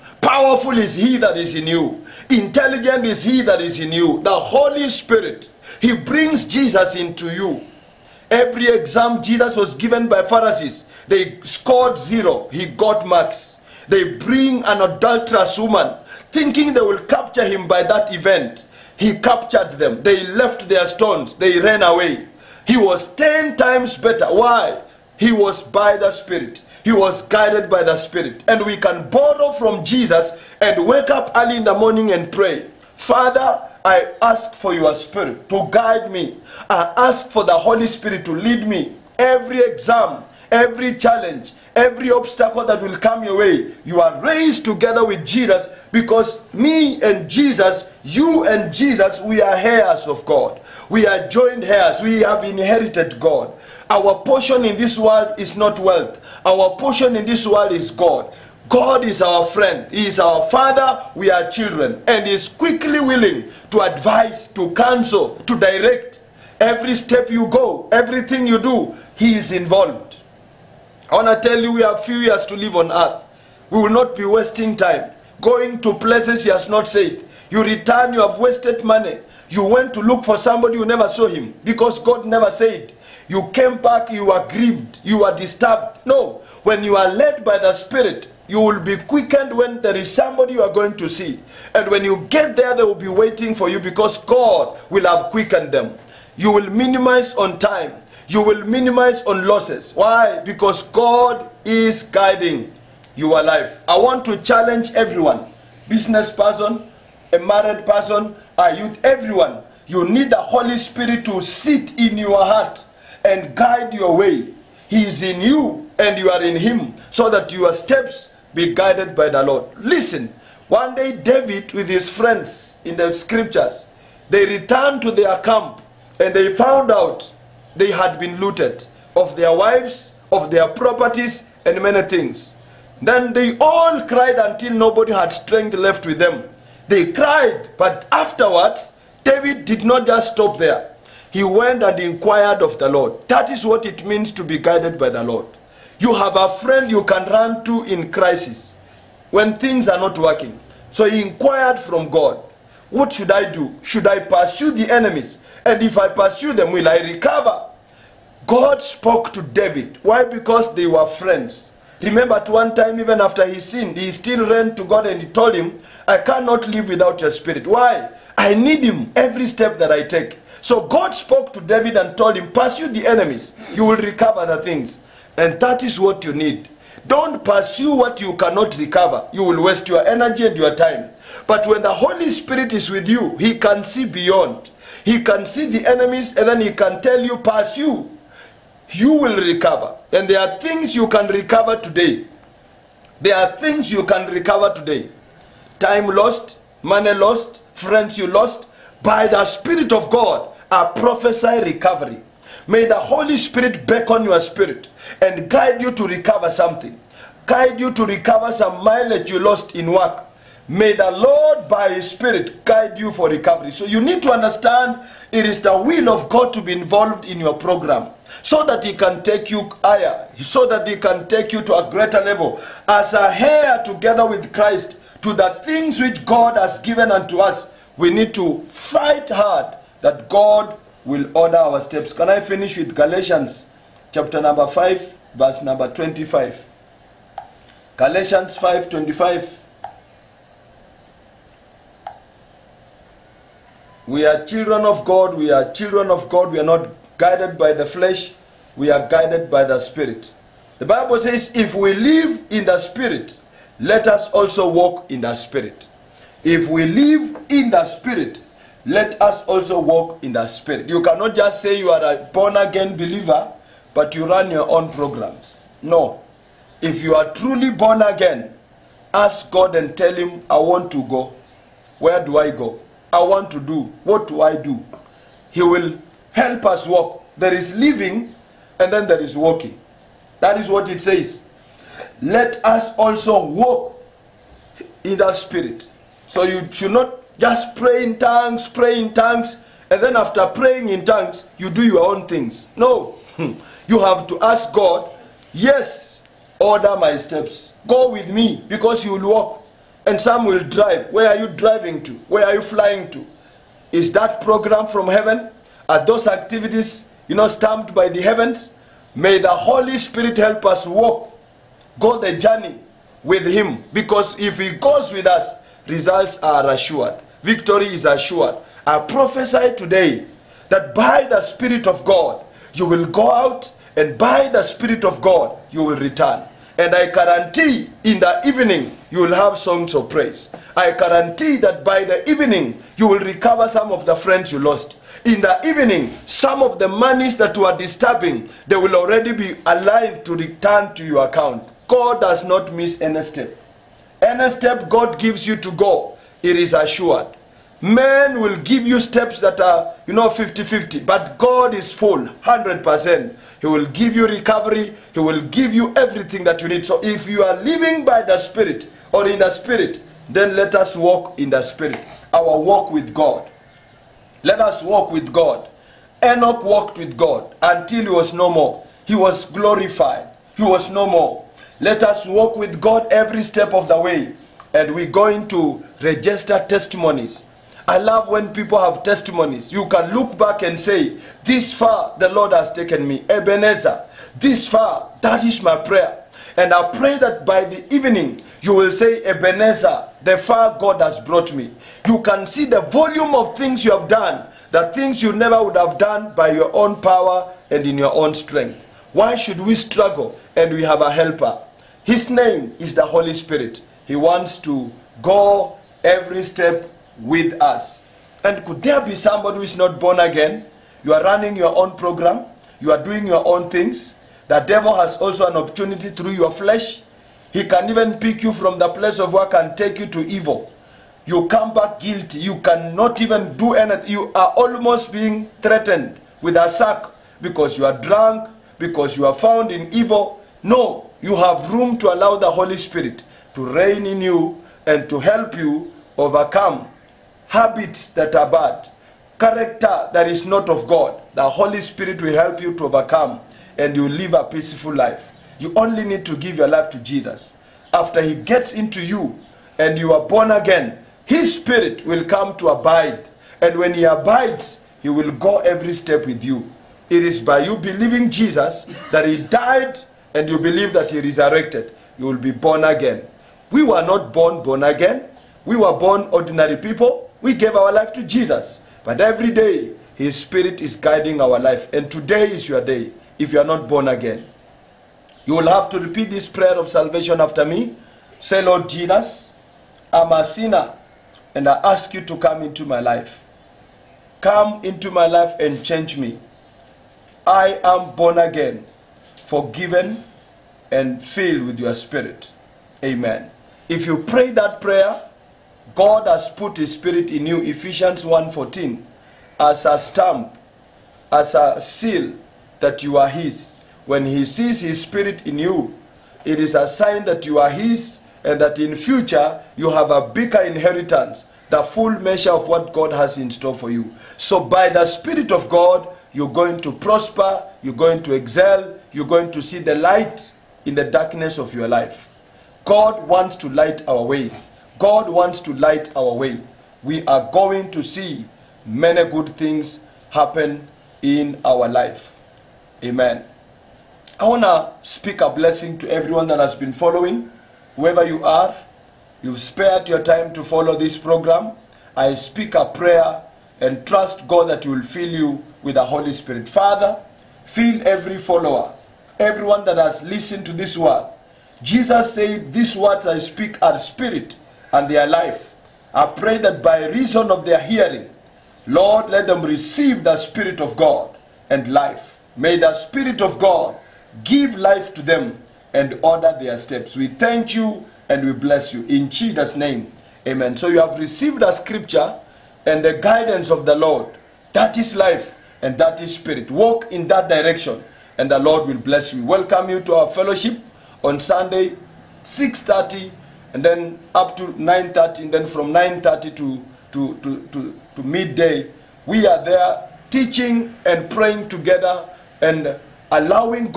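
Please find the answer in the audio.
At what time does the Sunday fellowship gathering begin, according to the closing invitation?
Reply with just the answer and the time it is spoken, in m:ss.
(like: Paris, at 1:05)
6:30, at 9:42.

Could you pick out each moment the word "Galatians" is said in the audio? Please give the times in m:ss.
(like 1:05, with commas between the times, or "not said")
3:52, 3:57.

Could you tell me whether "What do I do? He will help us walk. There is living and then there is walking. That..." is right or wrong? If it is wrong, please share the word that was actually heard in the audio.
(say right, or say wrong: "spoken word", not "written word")
right.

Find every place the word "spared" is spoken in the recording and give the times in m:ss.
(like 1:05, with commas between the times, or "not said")
8:59.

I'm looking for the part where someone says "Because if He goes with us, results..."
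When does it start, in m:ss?
5:13.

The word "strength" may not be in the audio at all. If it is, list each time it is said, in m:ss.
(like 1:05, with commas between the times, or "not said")
2:15, 6:38.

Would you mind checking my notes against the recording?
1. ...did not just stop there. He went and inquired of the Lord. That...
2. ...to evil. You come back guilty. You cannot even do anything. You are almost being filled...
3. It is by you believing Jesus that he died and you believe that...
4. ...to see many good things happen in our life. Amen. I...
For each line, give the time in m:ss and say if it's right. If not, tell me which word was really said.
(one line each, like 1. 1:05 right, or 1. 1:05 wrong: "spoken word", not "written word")
1. 2:19 right
2. 7:00 wrong: "threatened", not "filled"
3. 7:37 right
4. 8:47 right.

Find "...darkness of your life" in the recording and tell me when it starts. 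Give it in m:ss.
8:41.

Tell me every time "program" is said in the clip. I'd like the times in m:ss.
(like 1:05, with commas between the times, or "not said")
3:37, 4:24, 5:04, 6:51, 9:01.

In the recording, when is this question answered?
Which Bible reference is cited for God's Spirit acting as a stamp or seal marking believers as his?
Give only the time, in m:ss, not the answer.
8:17.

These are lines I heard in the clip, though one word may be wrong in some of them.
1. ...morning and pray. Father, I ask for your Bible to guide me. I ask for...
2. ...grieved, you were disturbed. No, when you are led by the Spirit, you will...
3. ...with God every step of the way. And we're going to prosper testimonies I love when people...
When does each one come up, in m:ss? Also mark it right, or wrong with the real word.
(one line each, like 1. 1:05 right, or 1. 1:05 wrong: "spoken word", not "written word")
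1. 0:31 wrong: "Spirit", not "Bible"
2. 1:24 right
3. 6:12 wrong: "register", not "prosper".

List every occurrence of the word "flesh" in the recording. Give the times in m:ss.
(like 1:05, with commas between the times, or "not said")
4:07, 6:56.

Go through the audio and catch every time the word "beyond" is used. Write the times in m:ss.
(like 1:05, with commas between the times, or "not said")
3:04.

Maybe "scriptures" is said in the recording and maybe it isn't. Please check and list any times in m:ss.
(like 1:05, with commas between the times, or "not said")
2:03, 9:31.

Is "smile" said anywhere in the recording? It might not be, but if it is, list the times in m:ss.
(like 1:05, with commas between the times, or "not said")
not said.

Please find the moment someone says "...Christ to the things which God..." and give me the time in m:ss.
3:44.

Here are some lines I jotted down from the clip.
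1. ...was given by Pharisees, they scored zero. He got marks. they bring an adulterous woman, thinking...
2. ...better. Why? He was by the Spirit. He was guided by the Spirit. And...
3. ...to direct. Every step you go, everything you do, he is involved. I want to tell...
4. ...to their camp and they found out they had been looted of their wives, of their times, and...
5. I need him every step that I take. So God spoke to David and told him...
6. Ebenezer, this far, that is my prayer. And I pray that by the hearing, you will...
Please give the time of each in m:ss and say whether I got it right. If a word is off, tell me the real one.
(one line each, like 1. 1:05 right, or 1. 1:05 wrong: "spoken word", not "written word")
1. 0:09 right
2. 0:23 right
3. 1:05 right
4. 2:05 wrong: "properties", not "times"
5. 2:48 right
6. 6:23 wrong: "evening", not "hearing".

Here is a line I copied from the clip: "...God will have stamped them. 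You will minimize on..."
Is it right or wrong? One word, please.
wrong.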